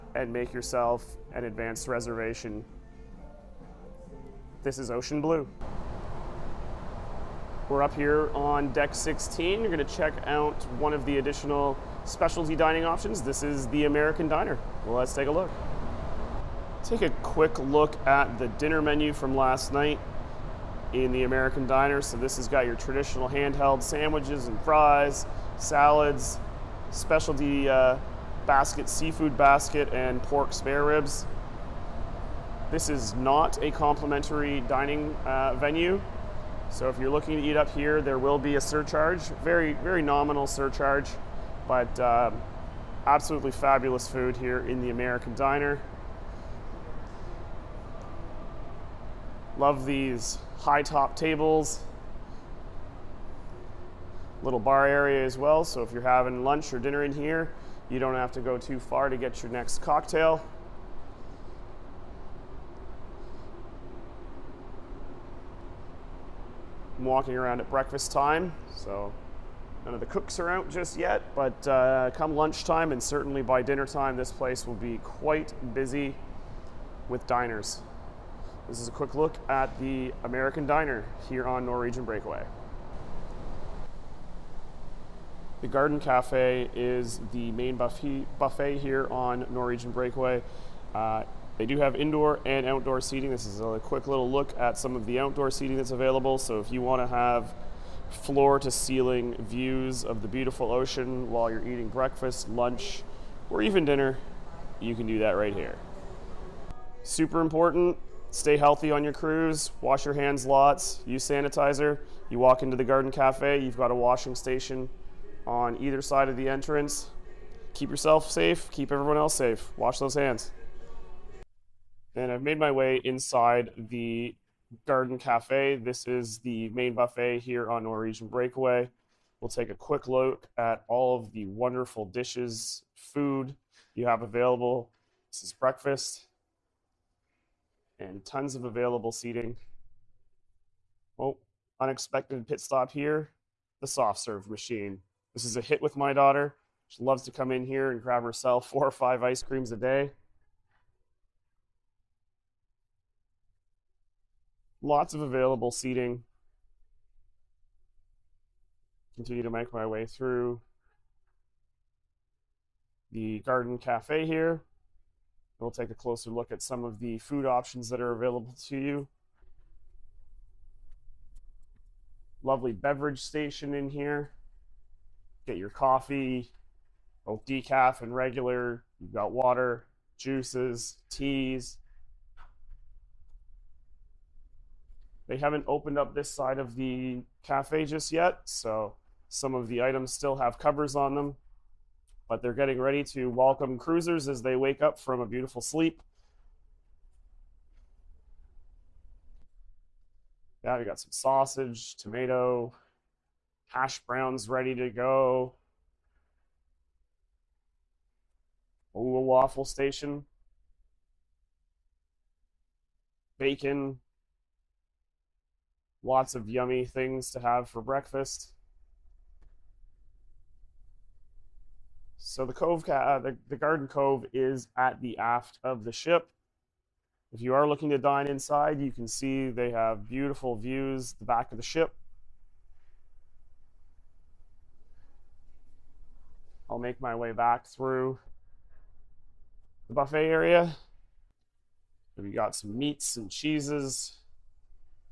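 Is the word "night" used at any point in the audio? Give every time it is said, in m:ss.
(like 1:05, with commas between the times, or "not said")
0:19.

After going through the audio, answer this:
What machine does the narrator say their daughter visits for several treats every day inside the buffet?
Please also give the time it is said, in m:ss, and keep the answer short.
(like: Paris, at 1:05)
Soft serve machine, at 2:23.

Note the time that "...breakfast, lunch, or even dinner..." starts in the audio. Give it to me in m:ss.
1:41.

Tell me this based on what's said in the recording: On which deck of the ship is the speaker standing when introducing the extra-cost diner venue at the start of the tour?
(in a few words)
16.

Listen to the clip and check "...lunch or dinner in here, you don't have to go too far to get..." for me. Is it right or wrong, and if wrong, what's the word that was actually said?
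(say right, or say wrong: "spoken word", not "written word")
right.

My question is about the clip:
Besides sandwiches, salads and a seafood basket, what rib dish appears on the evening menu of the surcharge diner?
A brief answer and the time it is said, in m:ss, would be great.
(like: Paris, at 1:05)
Pork spare ribs, at 0:30.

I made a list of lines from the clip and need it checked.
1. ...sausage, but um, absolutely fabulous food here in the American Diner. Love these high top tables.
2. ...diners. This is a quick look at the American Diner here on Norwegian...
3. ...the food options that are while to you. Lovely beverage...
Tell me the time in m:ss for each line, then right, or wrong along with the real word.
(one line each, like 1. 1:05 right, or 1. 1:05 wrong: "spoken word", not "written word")
1. 0:40 wrong: "surcharge", not "sausage"
2. 1:17 right
3. 2:46 wrong: "available", not "while".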